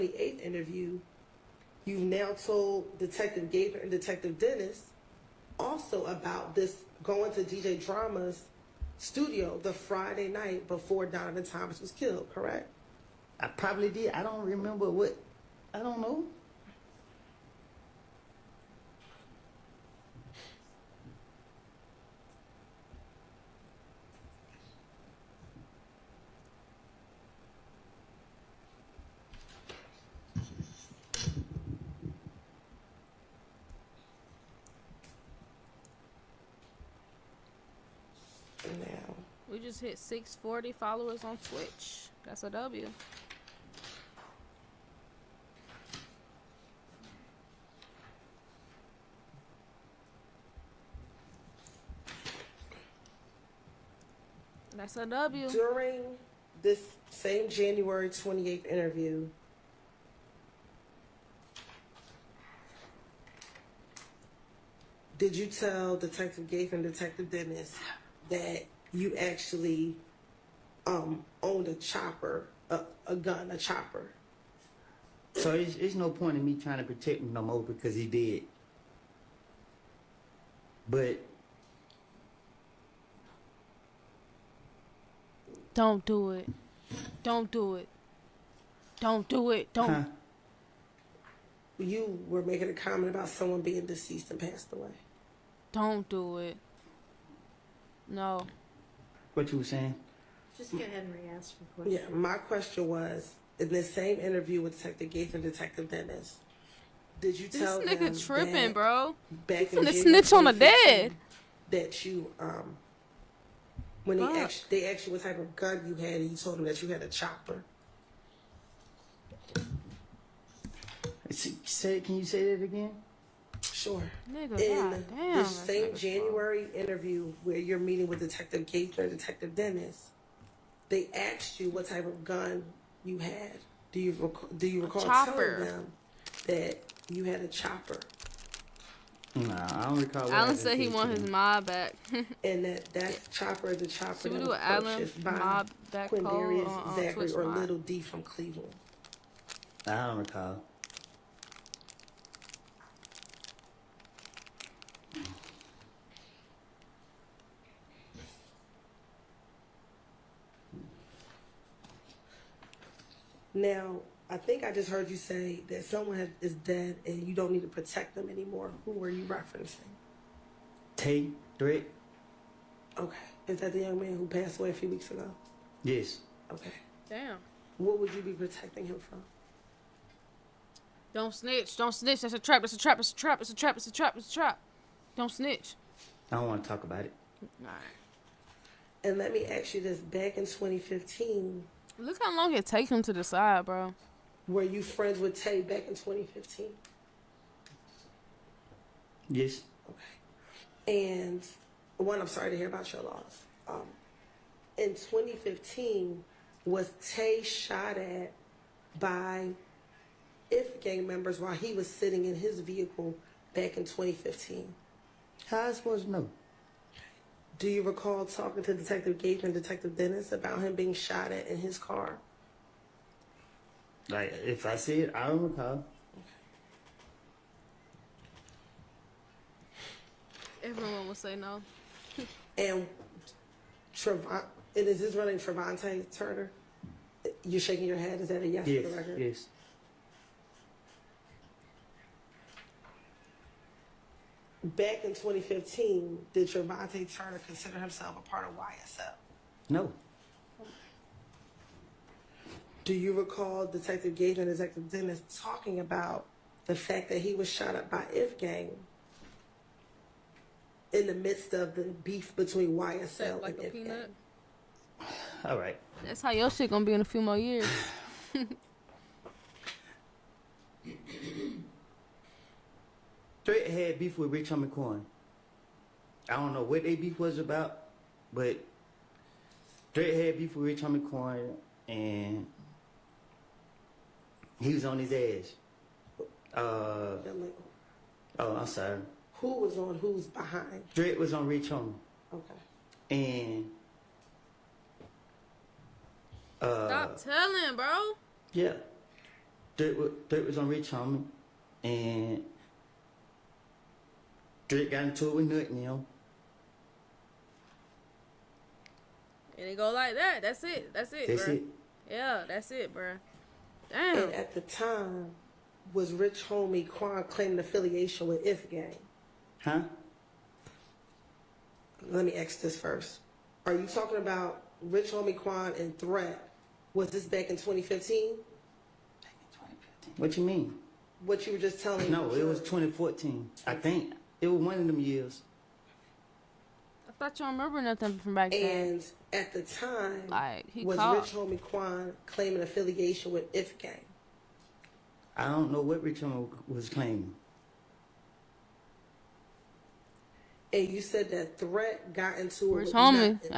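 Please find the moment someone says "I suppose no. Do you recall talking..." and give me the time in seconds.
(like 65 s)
215 s.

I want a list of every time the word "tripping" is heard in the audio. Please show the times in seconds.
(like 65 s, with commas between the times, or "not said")
108 s.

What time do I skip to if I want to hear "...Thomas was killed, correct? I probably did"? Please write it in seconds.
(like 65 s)
11 s.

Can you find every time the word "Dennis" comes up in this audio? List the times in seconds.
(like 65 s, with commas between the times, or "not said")
4 s, 67 s, 105 s, 129 s, 219 s, 254 s.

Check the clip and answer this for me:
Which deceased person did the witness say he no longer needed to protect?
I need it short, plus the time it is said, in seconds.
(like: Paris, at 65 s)
Tate Drake, at 170 s.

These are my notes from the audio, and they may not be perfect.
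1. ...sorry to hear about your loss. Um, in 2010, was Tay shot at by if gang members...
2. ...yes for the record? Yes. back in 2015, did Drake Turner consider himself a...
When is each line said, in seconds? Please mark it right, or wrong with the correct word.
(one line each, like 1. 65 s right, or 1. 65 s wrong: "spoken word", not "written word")
1. 202 s wrong: "2015", not "2010"
2. 238 s wrong: "Trevante", not "Drake".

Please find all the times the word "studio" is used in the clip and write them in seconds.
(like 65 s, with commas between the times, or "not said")
8 s.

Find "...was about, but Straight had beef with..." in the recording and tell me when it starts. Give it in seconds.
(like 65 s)
277 s.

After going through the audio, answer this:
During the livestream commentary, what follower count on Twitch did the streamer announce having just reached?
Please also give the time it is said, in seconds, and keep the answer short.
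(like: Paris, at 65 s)
640, at 39 s.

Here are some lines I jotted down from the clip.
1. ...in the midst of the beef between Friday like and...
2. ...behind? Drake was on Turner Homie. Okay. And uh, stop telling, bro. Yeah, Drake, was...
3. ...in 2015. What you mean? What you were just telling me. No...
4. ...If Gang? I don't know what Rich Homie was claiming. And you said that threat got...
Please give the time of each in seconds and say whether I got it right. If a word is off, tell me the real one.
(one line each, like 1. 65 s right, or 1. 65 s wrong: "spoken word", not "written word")
1. 260 s wrong: "YSL", not "Friday"
2. 290 s wrong: "Rich", not "Turner"
3. 328 s right
4. 343 s right.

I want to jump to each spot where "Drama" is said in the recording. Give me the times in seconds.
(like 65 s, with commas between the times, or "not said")
7 s.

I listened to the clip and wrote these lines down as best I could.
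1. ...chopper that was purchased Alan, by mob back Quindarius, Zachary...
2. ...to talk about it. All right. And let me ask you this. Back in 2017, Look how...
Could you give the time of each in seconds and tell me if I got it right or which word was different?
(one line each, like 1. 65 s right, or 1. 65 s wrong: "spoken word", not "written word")
1. 143 s right
2. 186 s wrong: "2015", not "2017".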